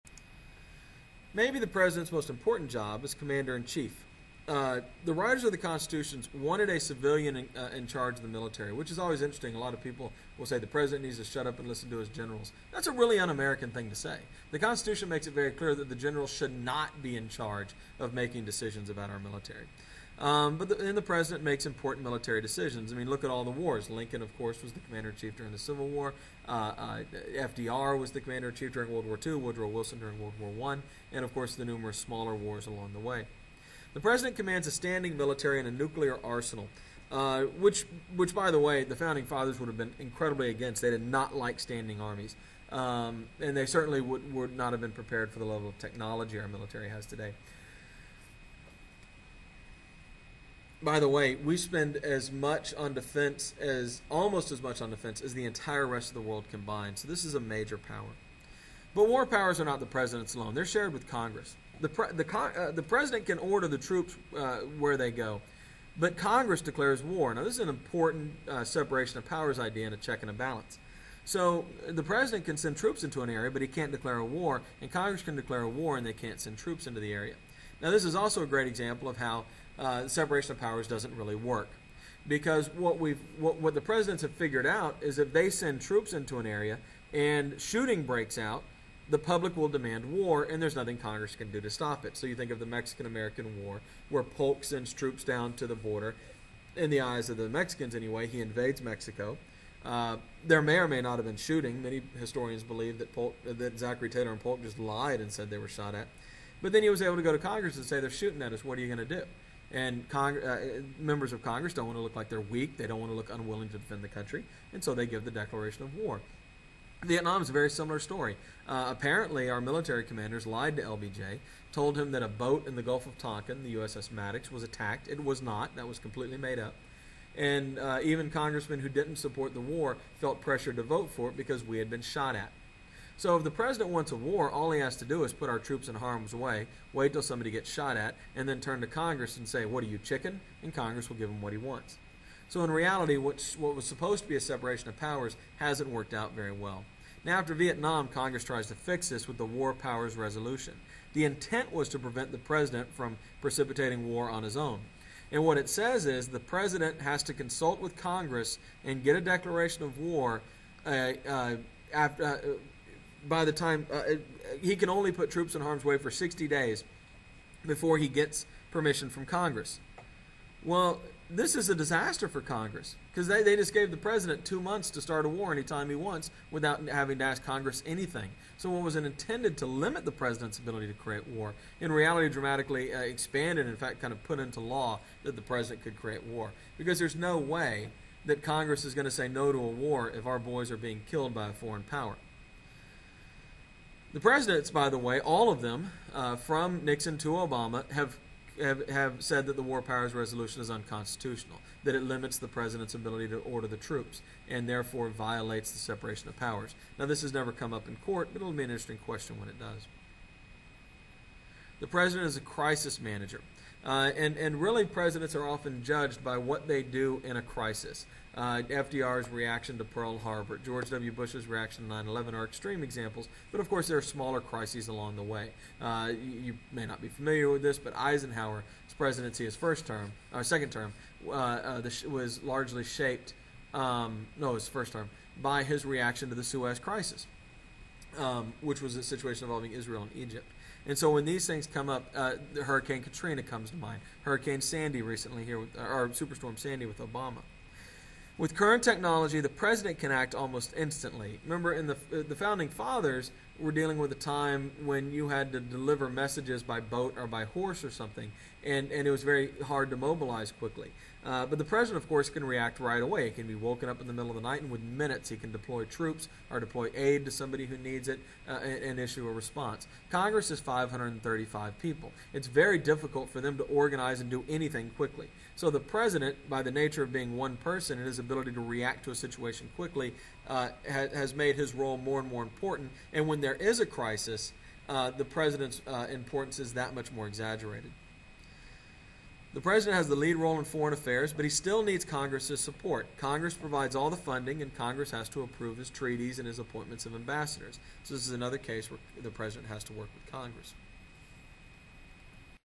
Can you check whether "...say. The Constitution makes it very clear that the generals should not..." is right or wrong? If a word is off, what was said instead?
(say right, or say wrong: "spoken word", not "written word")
right.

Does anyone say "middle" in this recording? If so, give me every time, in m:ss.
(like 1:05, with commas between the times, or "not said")
4:24.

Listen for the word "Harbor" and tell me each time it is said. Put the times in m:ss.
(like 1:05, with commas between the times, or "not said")
3:40.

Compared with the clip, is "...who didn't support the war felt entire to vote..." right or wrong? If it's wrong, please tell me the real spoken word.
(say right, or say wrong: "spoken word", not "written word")
wrong: "pressure", not "entire".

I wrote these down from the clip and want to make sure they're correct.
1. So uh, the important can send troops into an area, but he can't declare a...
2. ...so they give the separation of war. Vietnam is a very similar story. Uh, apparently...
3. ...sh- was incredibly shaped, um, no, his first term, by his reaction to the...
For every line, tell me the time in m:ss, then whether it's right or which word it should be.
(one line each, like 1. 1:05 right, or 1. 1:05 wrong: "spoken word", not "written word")
1. 1:11 wrong: "president", not "important"
2. 1:54 wrong: "declaration", not "separation"
3. 3:51 wrong: "largely", not "incredibly".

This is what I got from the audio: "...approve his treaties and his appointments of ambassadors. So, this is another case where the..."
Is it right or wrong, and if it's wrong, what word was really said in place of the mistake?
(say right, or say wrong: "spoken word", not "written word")
right.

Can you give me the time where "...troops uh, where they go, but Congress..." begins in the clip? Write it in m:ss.
1:03.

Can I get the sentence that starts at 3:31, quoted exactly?
The president is a crisis manager.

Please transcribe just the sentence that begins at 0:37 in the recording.
Uh, which, which, by the way, the founding fathers would have been incredibly against.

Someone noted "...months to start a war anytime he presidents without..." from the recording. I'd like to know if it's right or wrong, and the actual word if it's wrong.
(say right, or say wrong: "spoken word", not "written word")
wrong: "wants", not "presidents".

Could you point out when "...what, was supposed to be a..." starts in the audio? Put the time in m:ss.
2:23.